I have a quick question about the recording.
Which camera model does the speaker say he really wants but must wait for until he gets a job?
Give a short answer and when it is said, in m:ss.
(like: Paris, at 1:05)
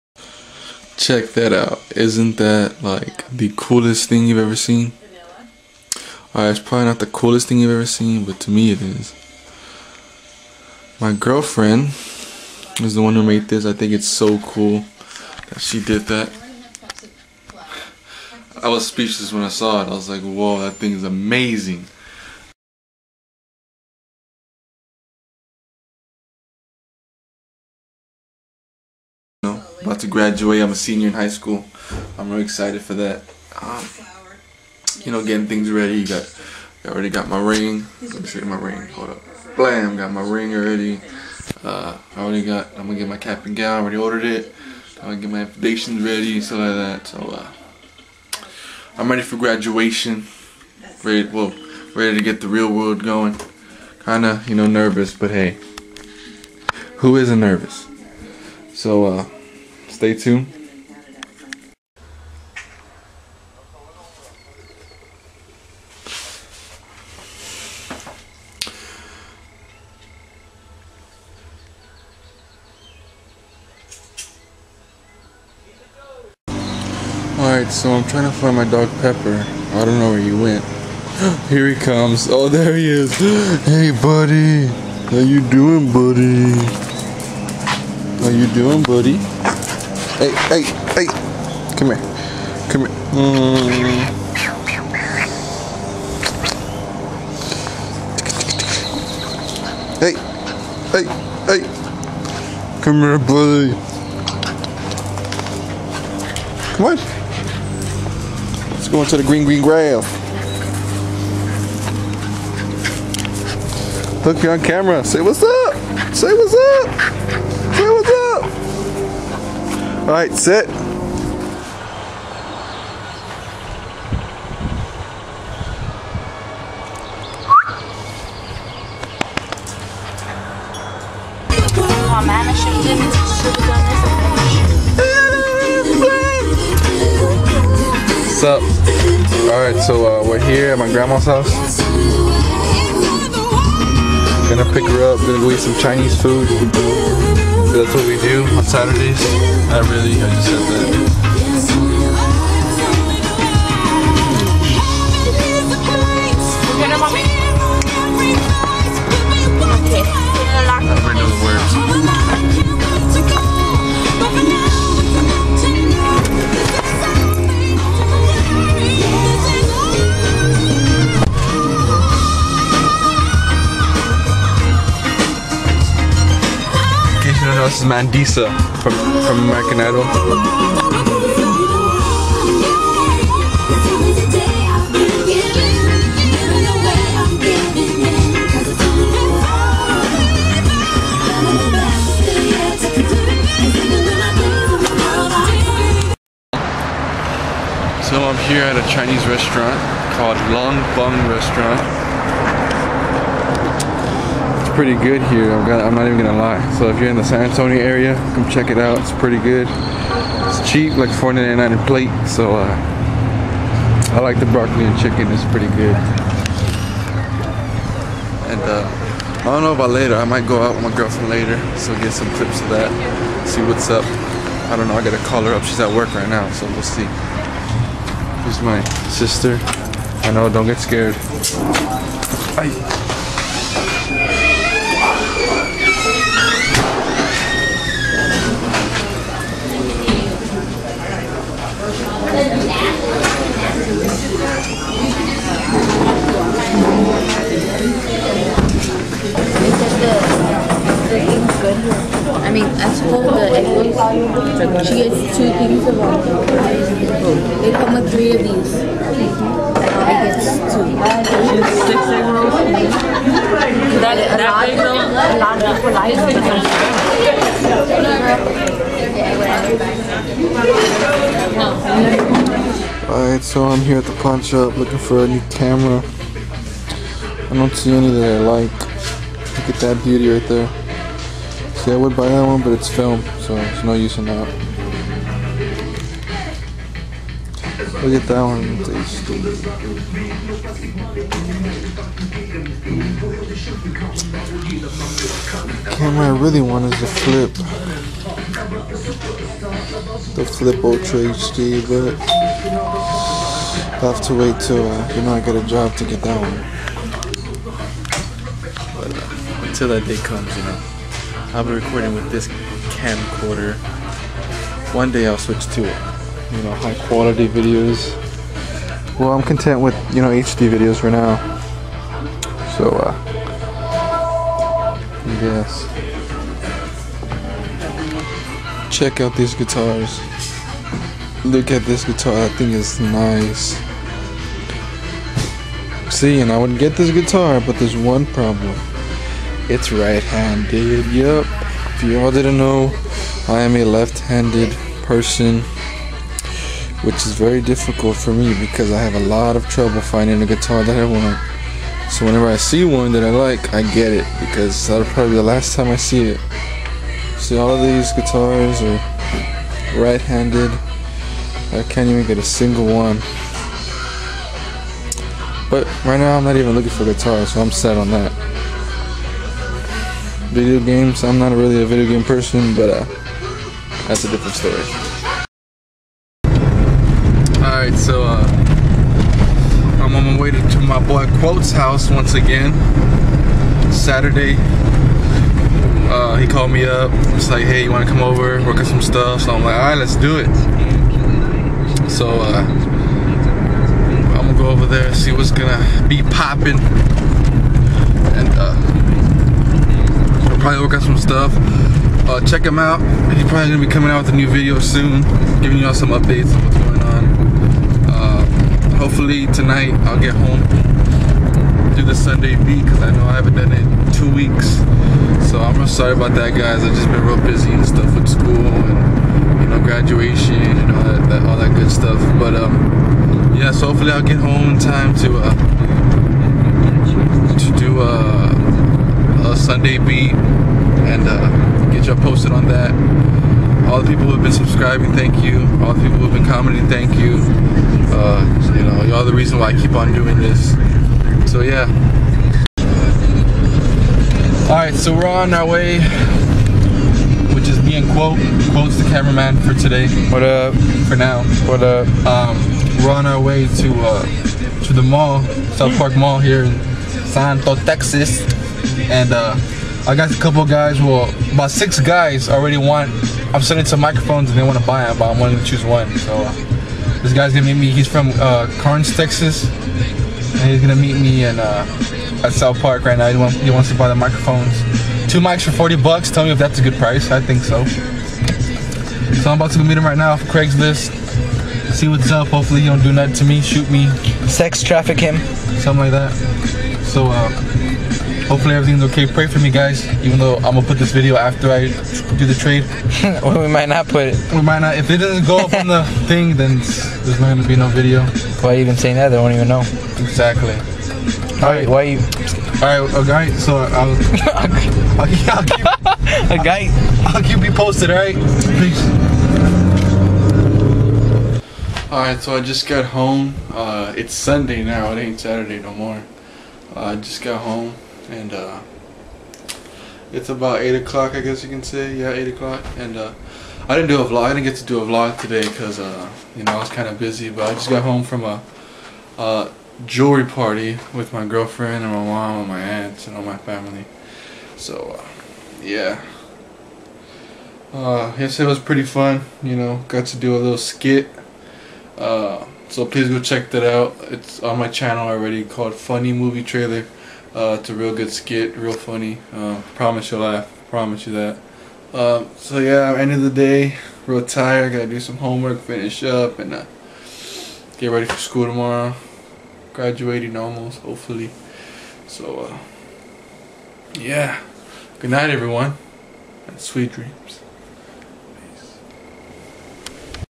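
Flip Ultra HD, at 5:00.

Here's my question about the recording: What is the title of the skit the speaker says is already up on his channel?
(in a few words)
Funny Movie Trailer.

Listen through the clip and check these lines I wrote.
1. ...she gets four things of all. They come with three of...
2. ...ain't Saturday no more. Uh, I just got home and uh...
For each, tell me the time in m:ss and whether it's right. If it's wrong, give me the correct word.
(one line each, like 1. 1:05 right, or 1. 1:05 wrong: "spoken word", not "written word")
1. 4:14 wrong: "two", not "four"
2. 8:35 right.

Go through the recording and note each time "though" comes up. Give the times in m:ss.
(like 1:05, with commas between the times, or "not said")
4:24, 8:10.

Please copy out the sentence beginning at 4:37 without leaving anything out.
I don't see any that I like.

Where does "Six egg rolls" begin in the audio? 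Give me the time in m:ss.
4:21.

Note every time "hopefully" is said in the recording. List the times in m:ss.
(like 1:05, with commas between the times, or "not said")
6:48, 7:03, 8:02, 8:08, 9:21.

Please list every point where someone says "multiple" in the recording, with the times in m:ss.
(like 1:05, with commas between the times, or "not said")
not said.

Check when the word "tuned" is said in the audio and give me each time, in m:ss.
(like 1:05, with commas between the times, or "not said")
1:00.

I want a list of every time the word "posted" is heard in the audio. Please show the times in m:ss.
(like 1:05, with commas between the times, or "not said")
7:12, 8:27.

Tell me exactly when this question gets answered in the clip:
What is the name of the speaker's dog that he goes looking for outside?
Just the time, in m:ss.
1:19.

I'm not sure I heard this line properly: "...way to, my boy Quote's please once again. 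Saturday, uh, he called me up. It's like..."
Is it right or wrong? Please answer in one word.
wrong.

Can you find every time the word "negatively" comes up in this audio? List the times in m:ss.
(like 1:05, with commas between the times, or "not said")
not said.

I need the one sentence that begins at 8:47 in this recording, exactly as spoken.
But I just got home from a jewelry party with my girlfriend and my mom and my aunts and all my family.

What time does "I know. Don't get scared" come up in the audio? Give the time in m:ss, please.
3:50.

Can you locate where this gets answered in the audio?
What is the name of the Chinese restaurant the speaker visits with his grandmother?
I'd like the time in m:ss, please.
3:20.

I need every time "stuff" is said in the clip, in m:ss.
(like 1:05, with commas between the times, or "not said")
0:46, 6:29, 6:41, 6:57, 7:01.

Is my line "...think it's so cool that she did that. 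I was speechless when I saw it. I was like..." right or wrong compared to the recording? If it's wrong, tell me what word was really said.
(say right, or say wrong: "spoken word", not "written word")
right.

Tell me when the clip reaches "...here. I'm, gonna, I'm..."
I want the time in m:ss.
3:25.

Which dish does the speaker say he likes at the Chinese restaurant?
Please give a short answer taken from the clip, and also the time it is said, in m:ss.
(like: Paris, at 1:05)
broccoli and chicken, at 3:34.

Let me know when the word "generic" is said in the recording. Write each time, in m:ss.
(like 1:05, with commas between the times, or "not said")
not said.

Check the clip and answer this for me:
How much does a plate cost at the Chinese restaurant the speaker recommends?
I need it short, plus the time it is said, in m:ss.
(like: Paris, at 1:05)
$4.99, at 3:31.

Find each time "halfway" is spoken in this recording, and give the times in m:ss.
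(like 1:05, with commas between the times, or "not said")
not said.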